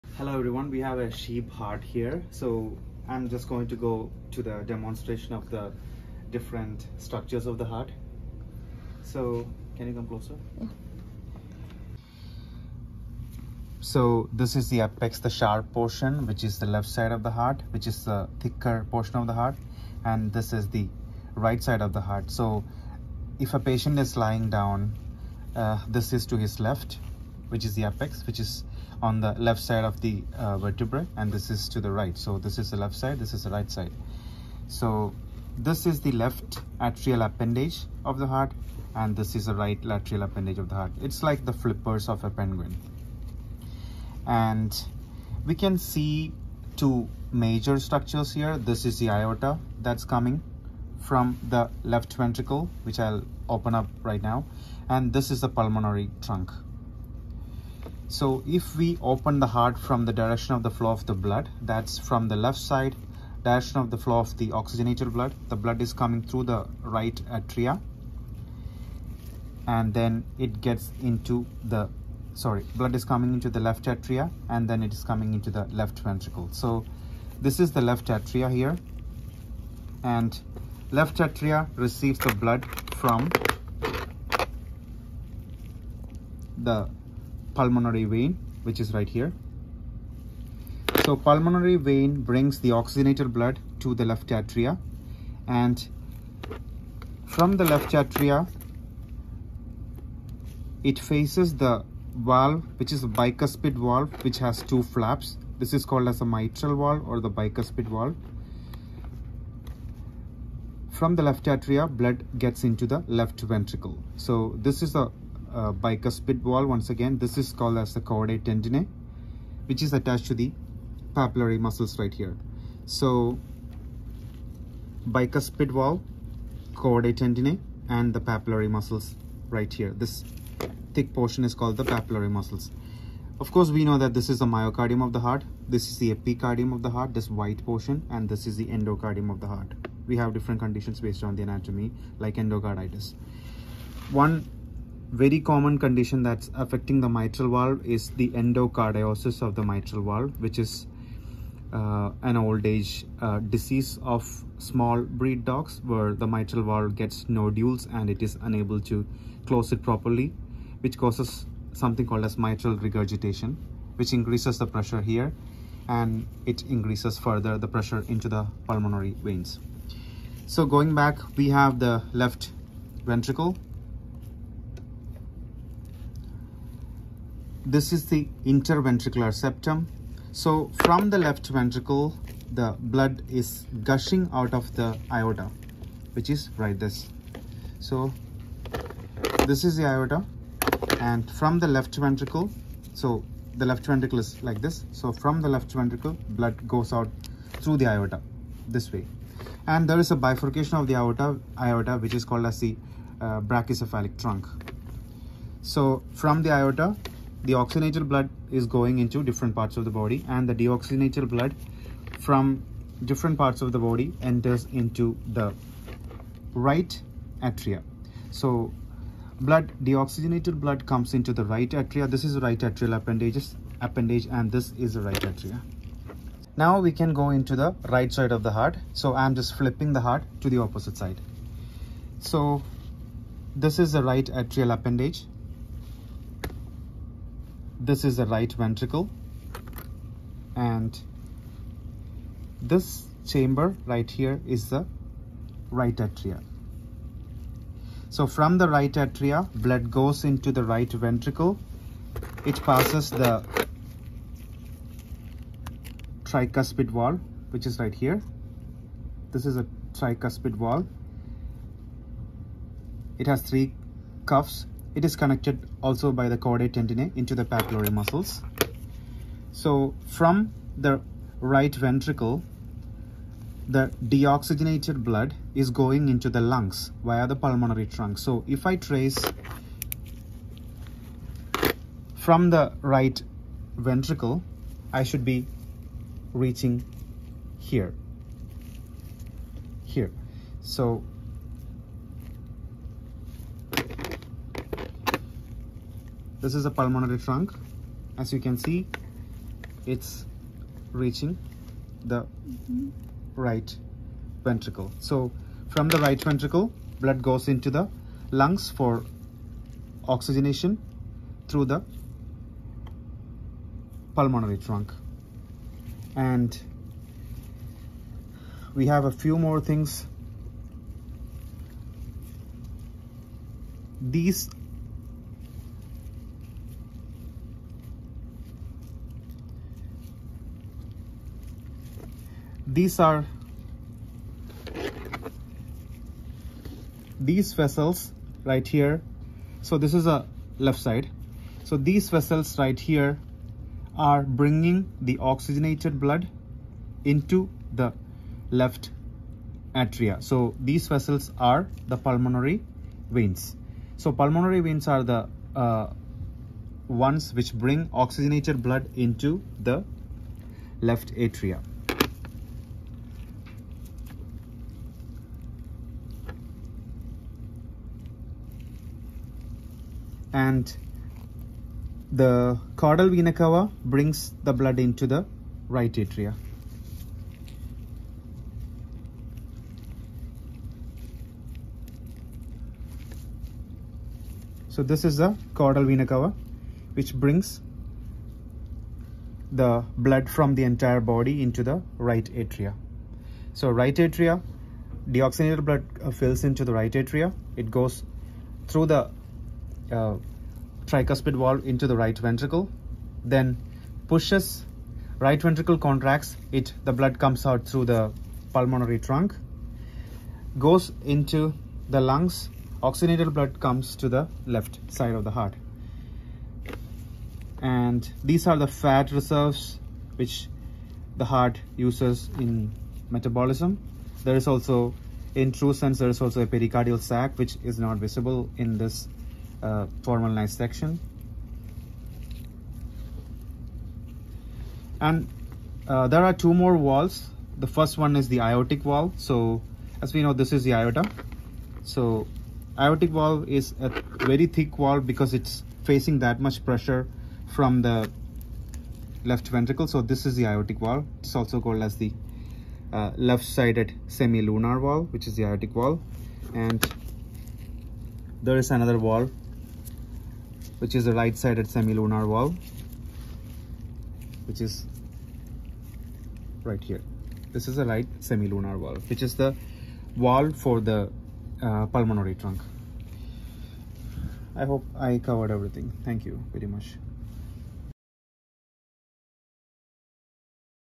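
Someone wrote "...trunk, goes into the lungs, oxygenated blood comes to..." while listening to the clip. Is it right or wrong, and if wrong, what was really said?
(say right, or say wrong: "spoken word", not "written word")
right.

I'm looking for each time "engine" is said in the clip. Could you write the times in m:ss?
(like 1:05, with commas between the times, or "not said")
not said.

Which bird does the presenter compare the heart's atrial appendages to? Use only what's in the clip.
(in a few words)
Penguin.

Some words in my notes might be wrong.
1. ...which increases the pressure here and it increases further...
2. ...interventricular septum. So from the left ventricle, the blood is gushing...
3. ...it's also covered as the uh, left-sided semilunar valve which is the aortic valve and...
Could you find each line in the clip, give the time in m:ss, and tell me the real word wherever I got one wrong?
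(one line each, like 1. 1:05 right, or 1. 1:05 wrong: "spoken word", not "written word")
1. 2:43 right
2. 2:58 right
3. 7:31 wrong: "called", not "covered".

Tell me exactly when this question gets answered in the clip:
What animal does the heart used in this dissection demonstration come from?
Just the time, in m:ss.
0:01.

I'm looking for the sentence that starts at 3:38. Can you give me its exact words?
So blood, deoxygenated blood comes into the right atria.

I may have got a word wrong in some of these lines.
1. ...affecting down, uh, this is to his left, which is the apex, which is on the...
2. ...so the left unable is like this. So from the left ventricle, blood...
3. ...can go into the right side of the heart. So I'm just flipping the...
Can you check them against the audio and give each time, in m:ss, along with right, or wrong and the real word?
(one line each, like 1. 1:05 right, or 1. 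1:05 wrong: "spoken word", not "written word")
1. 0:24 wrong: "lying", not "affecting"
2. 3:12 wrong: "ventricle", not "unable"
3. 3:46 right.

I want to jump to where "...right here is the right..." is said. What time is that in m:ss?
4:03.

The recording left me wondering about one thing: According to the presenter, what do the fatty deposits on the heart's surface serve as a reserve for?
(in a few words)
Metabolism.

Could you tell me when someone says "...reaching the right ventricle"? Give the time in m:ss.
5:00.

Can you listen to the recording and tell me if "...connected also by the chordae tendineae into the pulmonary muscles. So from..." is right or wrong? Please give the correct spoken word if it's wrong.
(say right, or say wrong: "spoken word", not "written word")
wrong: "papillary", not "pulmonary".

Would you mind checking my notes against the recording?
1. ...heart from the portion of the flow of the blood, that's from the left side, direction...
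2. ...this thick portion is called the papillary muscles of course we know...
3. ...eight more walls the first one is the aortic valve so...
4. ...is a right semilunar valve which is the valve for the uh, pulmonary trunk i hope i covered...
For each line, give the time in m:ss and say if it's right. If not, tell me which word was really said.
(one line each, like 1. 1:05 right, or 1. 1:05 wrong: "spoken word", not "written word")
1. 0:59 wrong: "direction", not "portion"
2. 2:10 right
3. 7:16 wrong: "two", not "eight"
4. 7:47 right.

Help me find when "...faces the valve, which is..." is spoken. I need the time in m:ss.
1:40.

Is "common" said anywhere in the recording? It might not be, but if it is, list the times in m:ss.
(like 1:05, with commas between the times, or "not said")
2:25.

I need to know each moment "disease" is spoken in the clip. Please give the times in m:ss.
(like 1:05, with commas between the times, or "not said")
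2:33.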